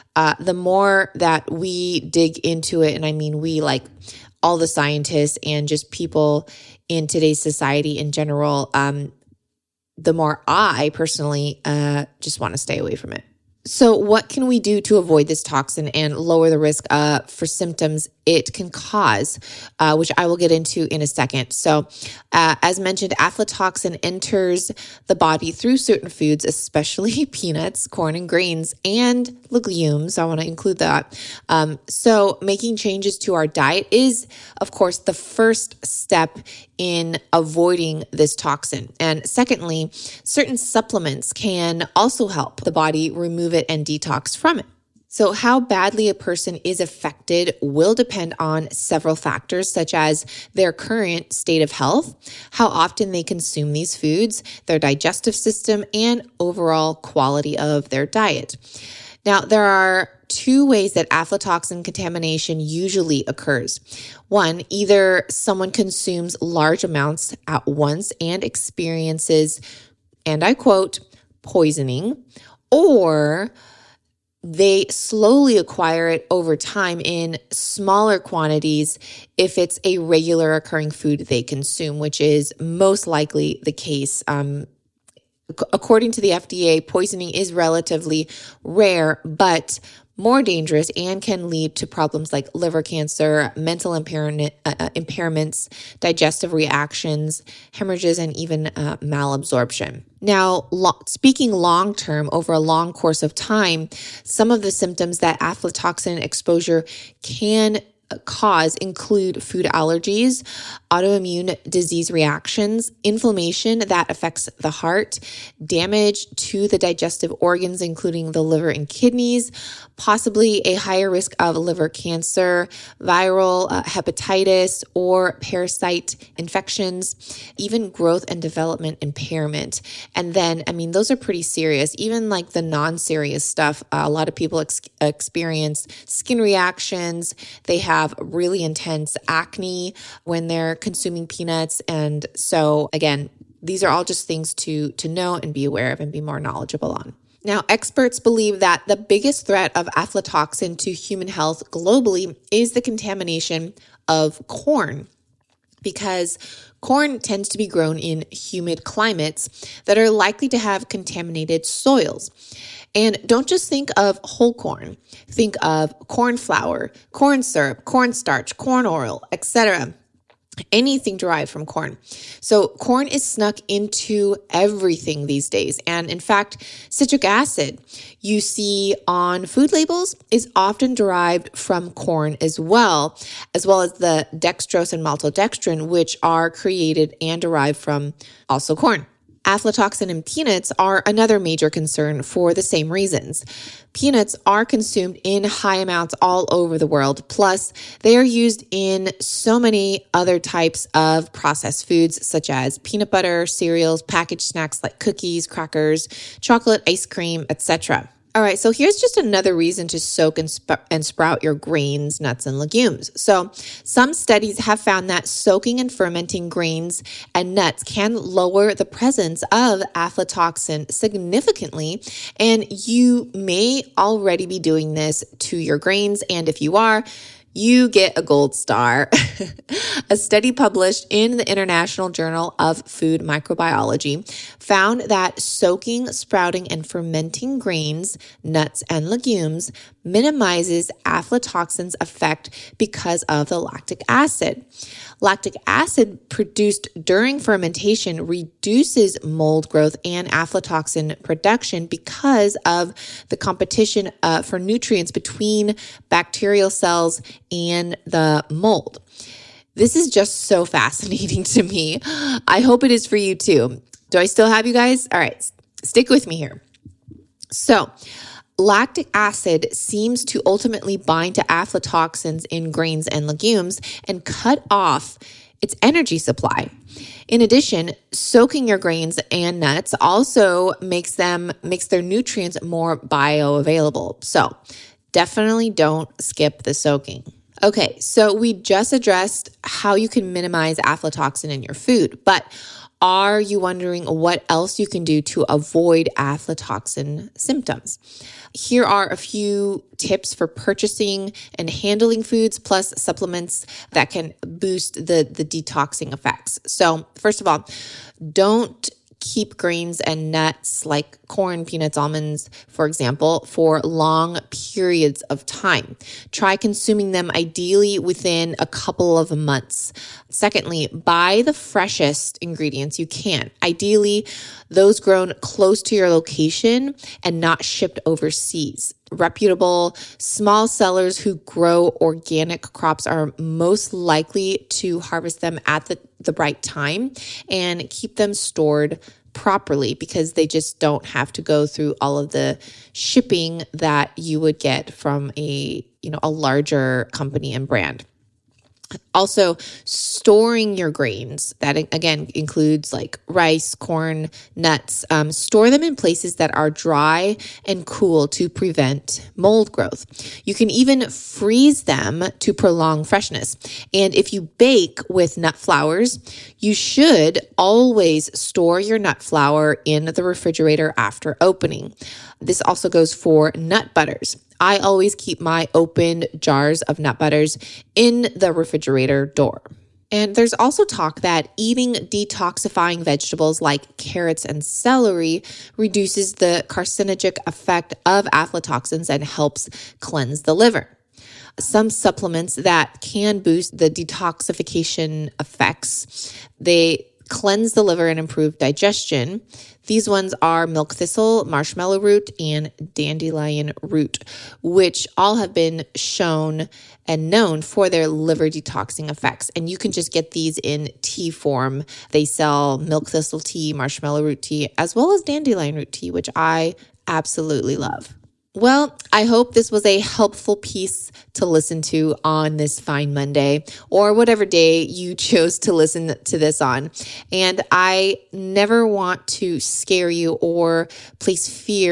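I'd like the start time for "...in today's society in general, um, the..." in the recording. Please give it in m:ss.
0:06.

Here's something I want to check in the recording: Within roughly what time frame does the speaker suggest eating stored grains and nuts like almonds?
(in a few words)
A couple of months.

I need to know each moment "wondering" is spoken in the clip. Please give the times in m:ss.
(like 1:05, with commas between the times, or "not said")
4:53.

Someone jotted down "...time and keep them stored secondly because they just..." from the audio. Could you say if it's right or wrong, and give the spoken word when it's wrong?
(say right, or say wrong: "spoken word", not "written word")
wrong: "properly", not "secondly".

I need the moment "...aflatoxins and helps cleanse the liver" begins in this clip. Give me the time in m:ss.
6:28.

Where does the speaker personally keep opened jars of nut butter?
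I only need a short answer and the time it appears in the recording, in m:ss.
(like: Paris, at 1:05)
Refrigerator door, at 6:18.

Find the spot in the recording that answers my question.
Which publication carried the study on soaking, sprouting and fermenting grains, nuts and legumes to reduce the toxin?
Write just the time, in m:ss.
3:51.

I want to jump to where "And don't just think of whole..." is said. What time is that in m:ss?
2:42.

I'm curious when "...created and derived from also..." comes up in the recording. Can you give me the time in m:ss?
3:06.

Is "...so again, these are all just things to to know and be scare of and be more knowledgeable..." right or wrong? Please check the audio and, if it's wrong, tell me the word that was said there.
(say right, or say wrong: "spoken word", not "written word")
wrong: "aware", not "scare".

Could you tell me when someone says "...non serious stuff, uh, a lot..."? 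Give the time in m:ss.
2:12.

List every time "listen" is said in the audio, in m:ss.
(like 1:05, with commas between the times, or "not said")
7:01, 7:05.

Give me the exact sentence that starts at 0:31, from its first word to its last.
Um, so, making changes to our diet is, of course, the first step in avoiding this toxin.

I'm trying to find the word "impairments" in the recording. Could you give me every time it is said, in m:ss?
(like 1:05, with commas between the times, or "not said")
1:34, 2:09.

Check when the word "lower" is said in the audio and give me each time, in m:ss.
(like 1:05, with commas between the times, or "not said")
0:16, 3:38.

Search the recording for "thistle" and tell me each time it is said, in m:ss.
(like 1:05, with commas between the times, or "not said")
6:40, 6:53.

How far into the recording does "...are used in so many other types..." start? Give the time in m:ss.
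3:18.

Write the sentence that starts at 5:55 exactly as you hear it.
Um, store them in places that are dry and cool to prevent mold growth.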